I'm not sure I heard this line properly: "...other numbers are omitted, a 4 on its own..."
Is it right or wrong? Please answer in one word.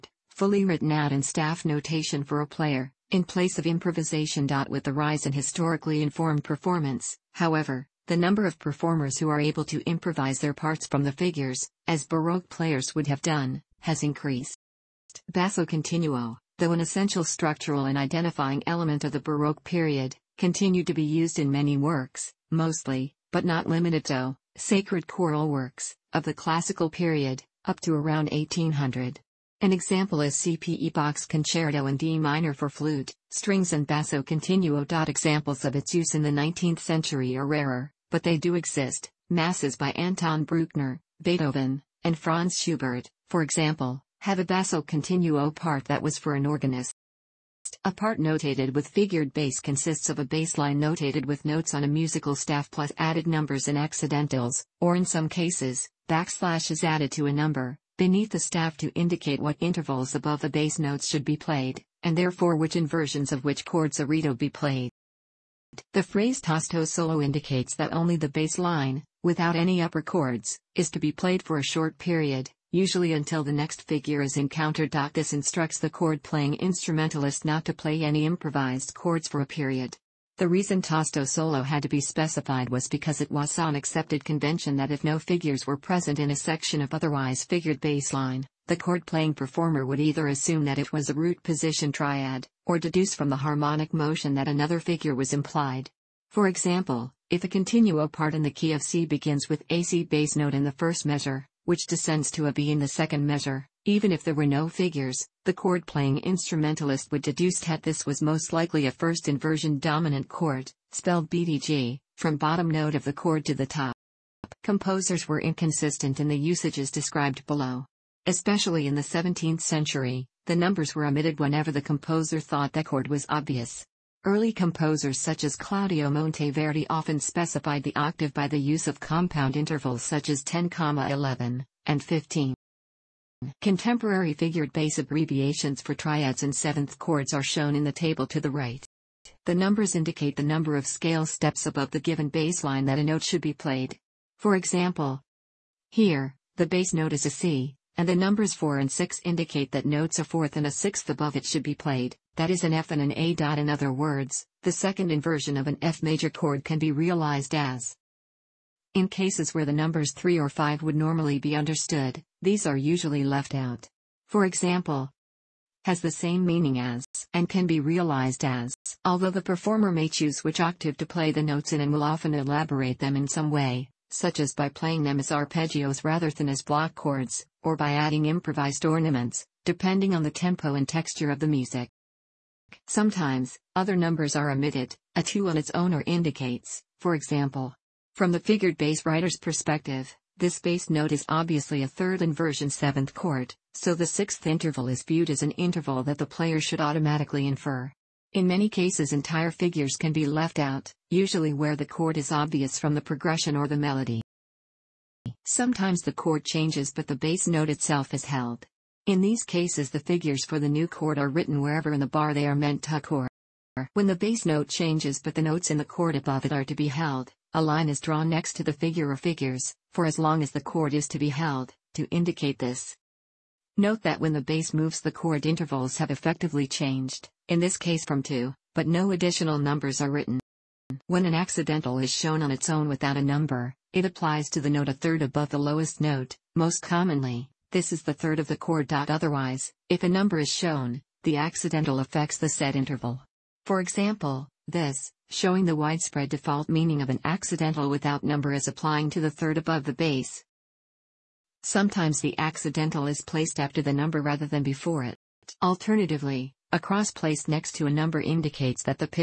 wrong.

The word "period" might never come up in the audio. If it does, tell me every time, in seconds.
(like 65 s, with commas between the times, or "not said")
19 s, 26 s, 71 s, 79 s.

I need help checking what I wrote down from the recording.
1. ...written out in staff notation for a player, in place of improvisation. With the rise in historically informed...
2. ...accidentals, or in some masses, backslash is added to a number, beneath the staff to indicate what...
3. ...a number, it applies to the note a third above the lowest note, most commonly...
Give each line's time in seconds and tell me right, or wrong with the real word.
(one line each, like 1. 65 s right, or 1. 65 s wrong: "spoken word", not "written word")
1. 0 s right
2. 53 s wrong: "cases", not "masses"
3. 233 s right.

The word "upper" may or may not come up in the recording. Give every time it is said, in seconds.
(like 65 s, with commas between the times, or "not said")
69 s.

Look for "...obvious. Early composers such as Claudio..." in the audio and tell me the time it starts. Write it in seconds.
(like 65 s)
123 s.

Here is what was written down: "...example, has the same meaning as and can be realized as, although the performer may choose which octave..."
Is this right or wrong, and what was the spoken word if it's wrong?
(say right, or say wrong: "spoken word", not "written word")
right.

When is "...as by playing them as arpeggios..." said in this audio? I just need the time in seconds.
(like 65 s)
174 s.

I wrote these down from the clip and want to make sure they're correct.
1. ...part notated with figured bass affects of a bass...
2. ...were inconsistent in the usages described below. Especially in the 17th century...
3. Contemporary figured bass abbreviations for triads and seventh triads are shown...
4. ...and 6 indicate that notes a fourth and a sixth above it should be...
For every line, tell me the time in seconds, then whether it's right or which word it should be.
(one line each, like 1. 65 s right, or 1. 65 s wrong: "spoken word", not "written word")
1. 47 s wrong: "consists", not "affects"
2. 115 s right
3. 133 s wrong: "chords", not "triads"
4. 148 s right.